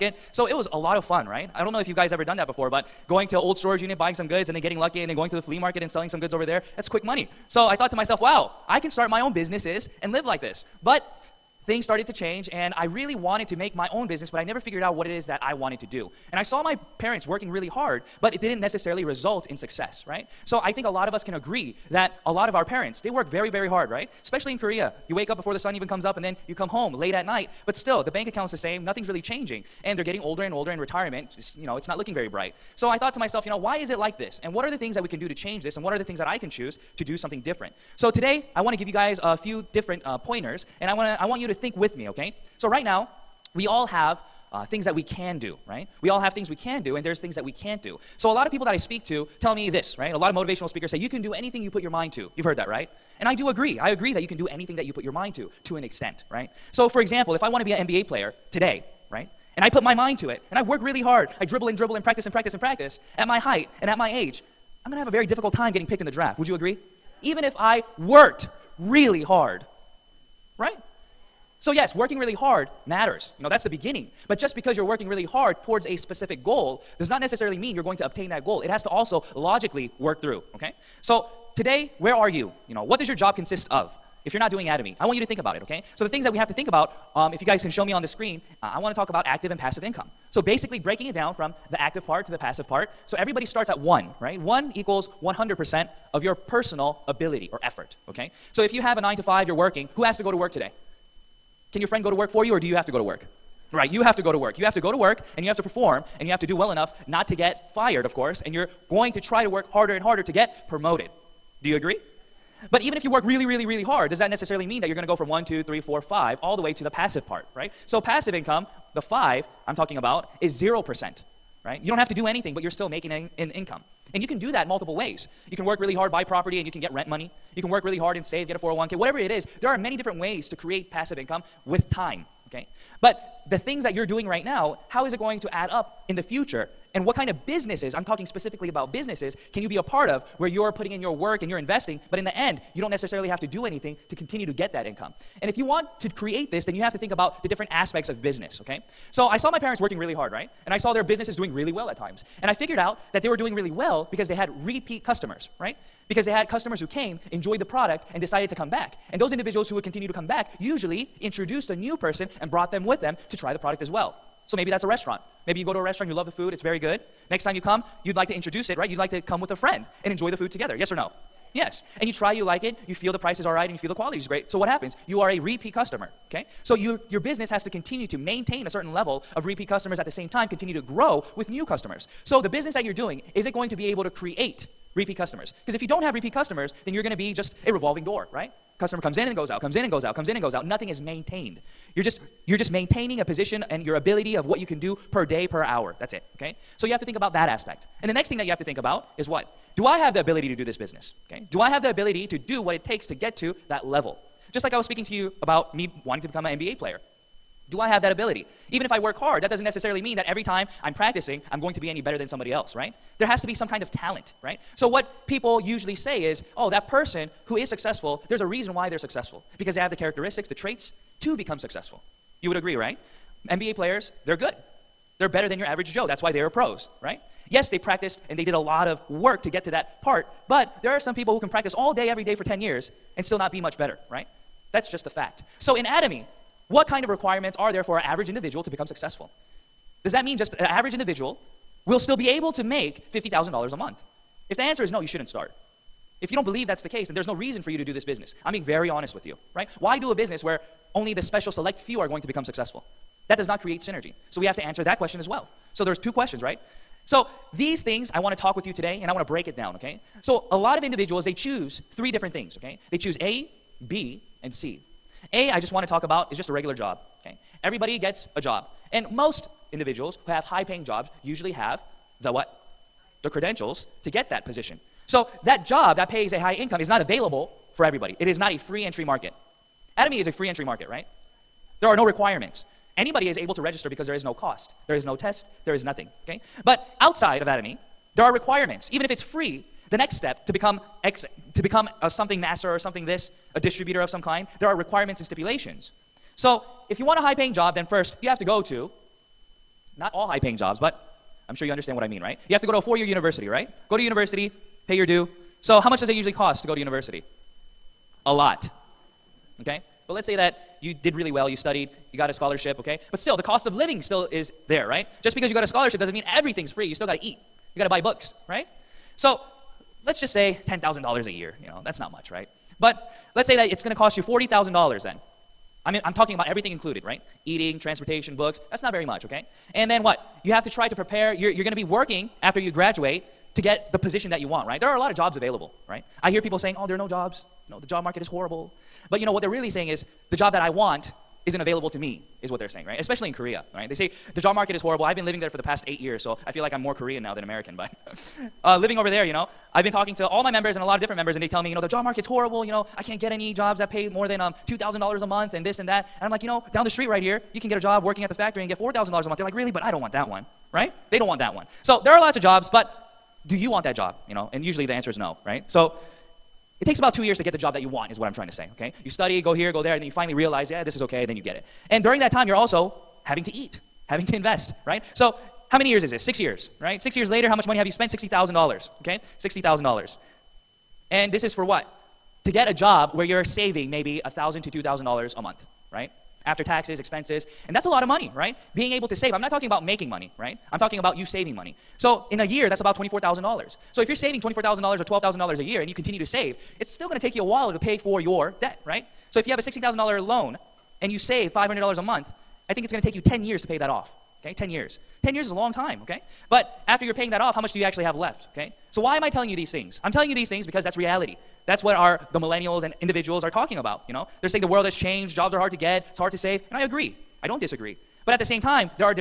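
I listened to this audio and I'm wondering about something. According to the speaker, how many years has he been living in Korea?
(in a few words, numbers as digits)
8 years.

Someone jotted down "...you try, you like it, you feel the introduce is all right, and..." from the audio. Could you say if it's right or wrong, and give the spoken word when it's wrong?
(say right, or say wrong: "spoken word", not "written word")
wrong: "price", not "introduce".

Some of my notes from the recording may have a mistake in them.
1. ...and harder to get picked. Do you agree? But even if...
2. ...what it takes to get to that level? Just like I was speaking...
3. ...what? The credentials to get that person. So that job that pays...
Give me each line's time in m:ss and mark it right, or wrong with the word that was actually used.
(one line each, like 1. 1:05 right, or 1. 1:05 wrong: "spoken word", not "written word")
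1. 1:49 wrong: "promoted", not "picked"
2. 3:22 right
3. 4:32 wrong: "position", not "person".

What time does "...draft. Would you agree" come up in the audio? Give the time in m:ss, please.
1:06.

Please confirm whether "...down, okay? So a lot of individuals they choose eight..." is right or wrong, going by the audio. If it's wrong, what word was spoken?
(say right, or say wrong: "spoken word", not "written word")
wrong: "three", not "eight".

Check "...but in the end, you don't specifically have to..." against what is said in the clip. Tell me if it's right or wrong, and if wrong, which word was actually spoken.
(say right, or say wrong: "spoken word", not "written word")
wrong: "necessarily", not "specifically".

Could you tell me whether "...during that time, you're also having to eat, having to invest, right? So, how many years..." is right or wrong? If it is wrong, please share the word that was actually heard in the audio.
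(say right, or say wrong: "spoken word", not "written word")
right.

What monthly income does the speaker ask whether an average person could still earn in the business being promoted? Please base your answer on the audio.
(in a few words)
$50,000.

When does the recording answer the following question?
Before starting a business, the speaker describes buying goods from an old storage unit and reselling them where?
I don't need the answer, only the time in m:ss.
0:05.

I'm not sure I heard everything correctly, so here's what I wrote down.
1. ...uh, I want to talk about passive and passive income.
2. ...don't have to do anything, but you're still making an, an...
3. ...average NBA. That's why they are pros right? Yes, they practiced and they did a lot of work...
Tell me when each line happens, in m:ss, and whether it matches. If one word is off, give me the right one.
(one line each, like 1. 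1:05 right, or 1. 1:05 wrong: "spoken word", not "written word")
1. 1:28 wrong: "active", not "passive"
2. 2:01 right
3. 3:45 wrong: "Joe", not "NBA".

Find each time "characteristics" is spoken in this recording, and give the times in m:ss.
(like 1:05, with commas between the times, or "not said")
3:39.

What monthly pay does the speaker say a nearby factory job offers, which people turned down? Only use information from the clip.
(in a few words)
$4,000.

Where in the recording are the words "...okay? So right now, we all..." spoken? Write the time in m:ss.
0:42.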